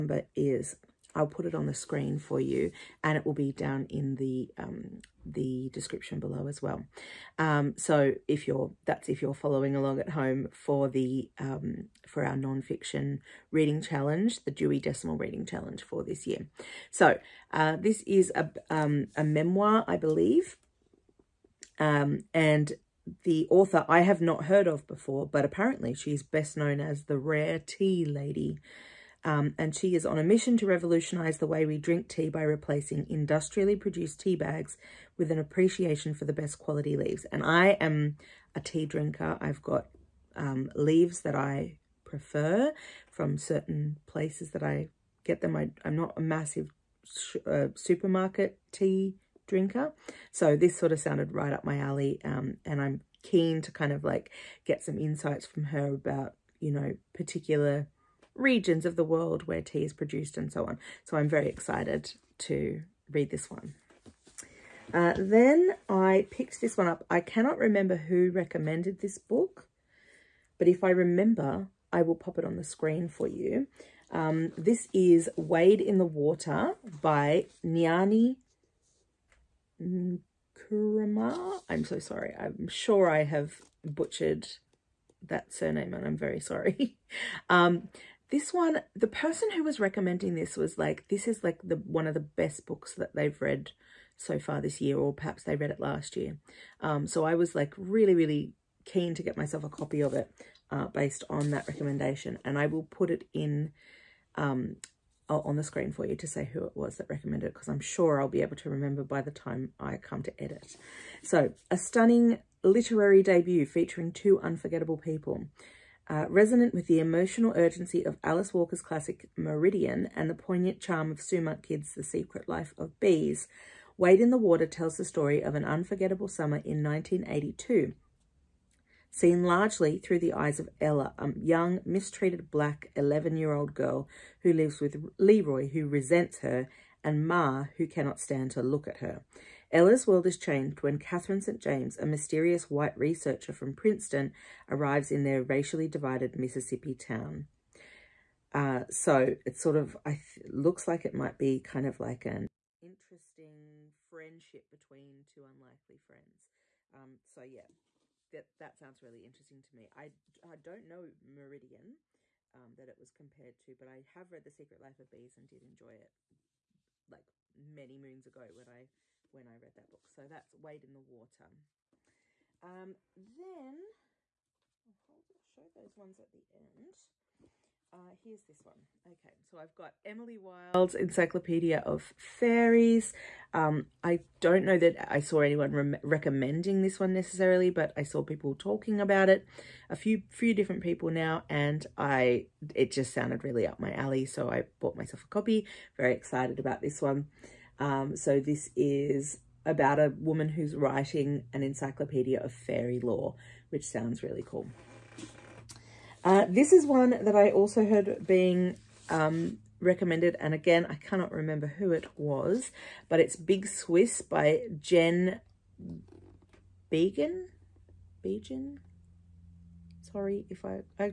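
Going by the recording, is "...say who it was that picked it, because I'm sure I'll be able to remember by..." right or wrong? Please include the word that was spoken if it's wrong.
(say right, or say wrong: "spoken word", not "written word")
wrong: "recommended", not "picked".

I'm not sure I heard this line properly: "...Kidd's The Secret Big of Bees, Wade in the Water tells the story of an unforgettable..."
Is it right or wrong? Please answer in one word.
wrong.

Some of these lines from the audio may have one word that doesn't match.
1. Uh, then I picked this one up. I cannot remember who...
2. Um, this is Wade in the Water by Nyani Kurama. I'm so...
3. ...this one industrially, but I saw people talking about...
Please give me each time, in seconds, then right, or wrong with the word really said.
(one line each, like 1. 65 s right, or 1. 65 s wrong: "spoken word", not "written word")
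1. 64 s right
2. 74 s right
3. 186 s wrong: "necessarily", not "industrially".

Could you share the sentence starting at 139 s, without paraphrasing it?
Ella's world is changed when Catherine St.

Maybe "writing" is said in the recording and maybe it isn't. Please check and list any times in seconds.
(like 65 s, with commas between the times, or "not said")
200 s.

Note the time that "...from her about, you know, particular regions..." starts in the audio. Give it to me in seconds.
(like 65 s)
55 s.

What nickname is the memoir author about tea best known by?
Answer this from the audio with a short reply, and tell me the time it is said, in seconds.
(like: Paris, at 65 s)
Rare Tea Lady, at 27 s.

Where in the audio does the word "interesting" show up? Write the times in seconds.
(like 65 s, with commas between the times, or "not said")
152 s, 159 s.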